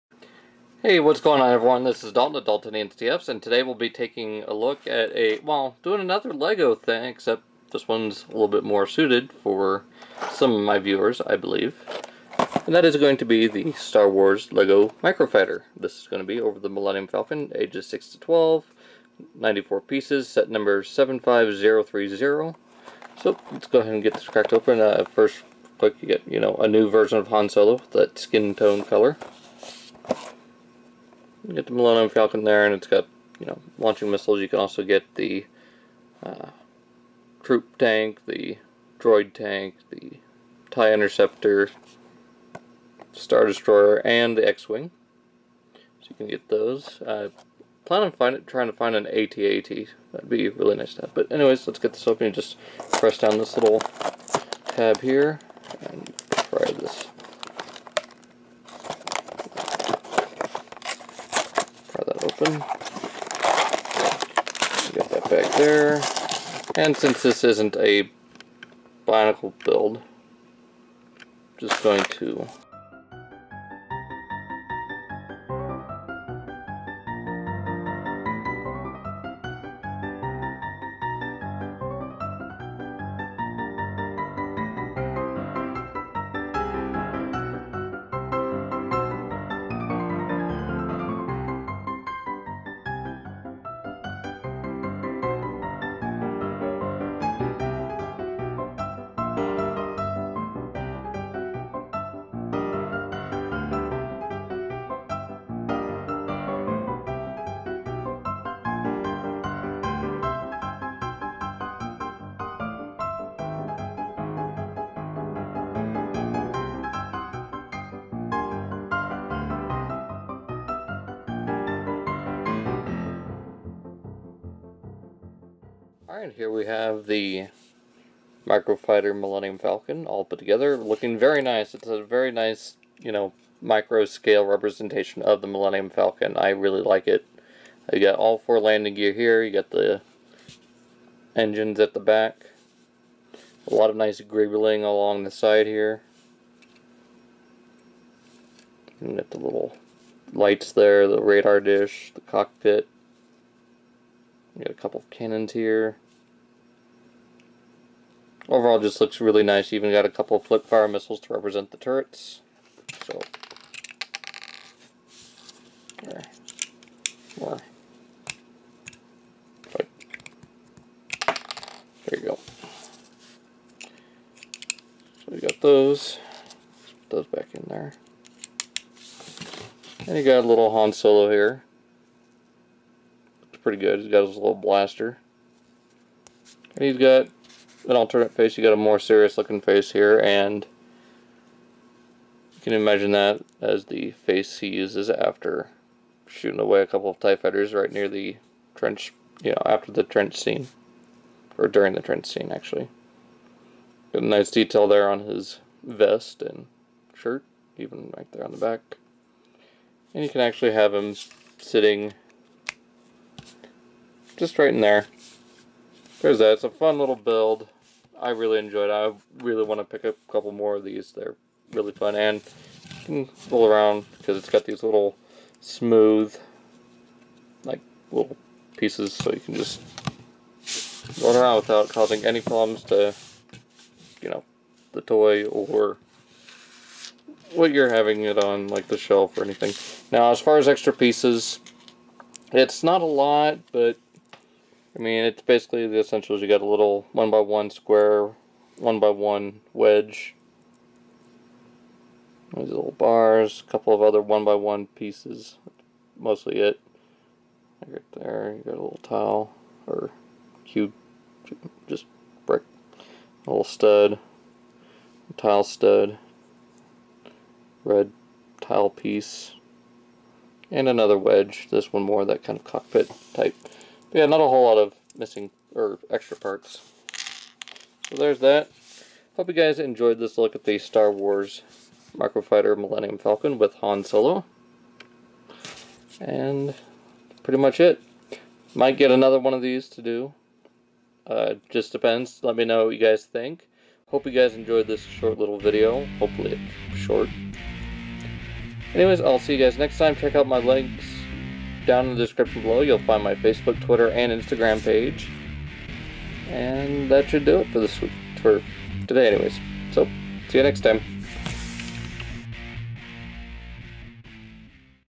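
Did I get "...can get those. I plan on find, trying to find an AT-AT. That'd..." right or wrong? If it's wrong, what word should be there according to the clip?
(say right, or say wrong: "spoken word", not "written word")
right.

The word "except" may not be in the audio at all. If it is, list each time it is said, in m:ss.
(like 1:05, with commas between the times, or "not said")
0:07.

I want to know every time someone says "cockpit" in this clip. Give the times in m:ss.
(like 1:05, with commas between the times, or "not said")
2:32, 4:32.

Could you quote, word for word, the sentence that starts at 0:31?
You get the Millennium Falcon there, and it's got, you know, launching missiles.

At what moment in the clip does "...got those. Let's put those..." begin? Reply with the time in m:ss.
2:55.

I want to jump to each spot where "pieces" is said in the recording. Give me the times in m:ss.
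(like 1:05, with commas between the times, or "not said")
0:19, 3:48, 4:00, 4:14, 4:28.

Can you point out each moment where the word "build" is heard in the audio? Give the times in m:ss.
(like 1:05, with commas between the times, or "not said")
1:09, 3:37.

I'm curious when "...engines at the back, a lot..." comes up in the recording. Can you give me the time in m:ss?
2:21.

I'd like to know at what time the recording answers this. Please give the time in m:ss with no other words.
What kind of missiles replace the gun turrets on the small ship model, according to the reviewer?
2:40.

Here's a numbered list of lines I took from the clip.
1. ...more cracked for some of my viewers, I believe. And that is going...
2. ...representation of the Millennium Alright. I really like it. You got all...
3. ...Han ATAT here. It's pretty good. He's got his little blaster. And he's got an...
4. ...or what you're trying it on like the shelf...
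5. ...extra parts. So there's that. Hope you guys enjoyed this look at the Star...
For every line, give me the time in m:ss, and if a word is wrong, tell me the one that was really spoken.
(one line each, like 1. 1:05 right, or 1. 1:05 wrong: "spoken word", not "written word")
1. 0:08 wrong: "suited", not "cracked"
2. 2:14 wrong: "Falcon", not "Alright"
3. 3:00 wrong: "Solo", not "ATAT"
4. 3:55 wrong: "having", not "trying"
5. 4:36 right.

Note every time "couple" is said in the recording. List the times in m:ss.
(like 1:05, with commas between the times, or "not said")
2:34, 2:40, 3:16, 3:40, 4:13.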